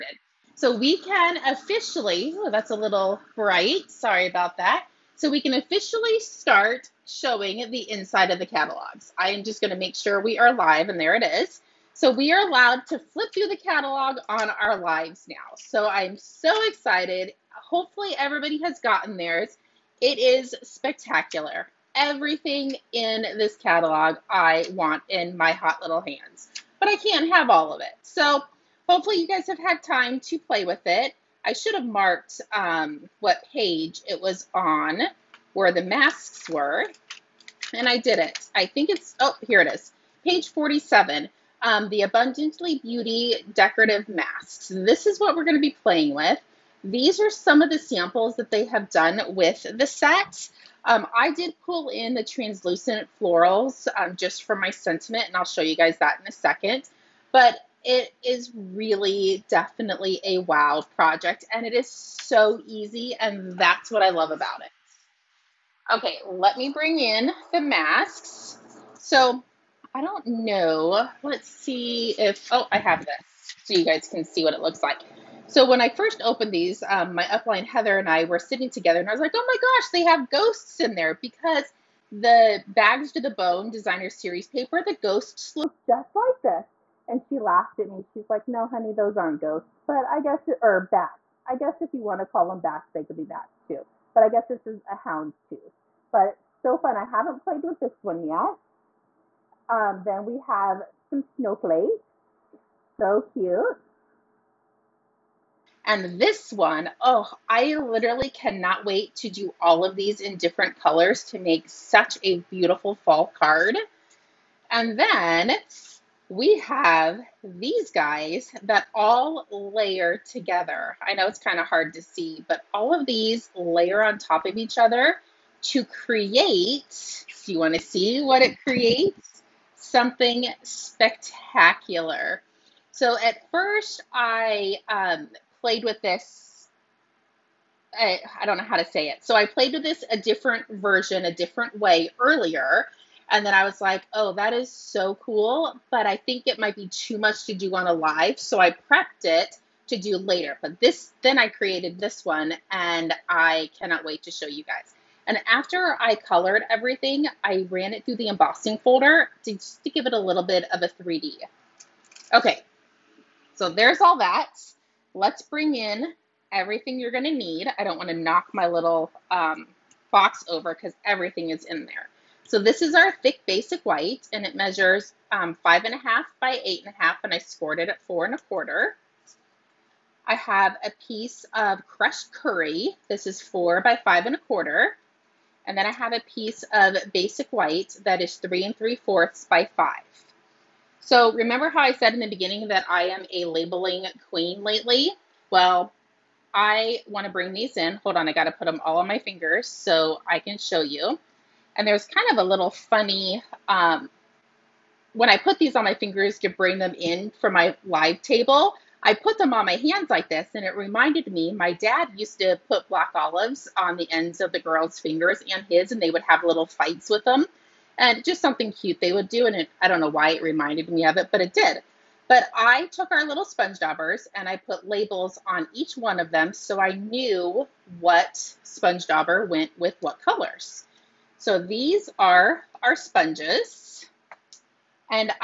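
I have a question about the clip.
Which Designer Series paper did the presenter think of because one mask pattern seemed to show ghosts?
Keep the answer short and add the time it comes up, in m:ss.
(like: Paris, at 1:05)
Bags to the Bone, at 1:22.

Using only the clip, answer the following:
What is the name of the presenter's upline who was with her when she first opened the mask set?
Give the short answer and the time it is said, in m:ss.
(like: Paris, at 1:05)
Heather, at 1:17.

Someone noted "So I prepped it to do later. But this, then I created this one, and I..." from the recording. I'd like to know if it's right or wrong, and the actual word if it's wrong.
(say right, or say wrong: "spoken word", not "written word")
right.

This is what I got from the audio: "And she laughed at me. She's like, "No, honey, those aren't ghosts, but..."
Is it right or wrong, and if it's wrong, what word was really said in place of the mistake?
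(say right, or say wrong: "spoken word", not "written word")
right.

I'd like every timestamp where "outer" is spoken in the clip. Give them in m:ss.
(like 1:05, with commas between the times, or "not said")
not said.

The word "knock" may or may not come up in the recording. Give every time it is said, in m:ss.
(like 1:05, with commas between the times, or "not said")
2:48.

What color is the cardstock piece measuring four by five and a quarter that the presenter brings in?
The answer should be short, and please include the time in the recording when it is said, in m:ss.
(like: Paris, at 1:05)
crushed curry, at 3:01.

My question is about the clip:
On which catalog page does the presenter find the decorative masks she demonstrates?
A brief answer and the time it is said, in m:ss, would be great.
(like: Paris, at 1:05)
47, at 0:40.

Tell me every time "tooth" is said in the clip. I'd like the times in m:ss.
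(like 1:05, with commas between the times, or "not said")
1:35.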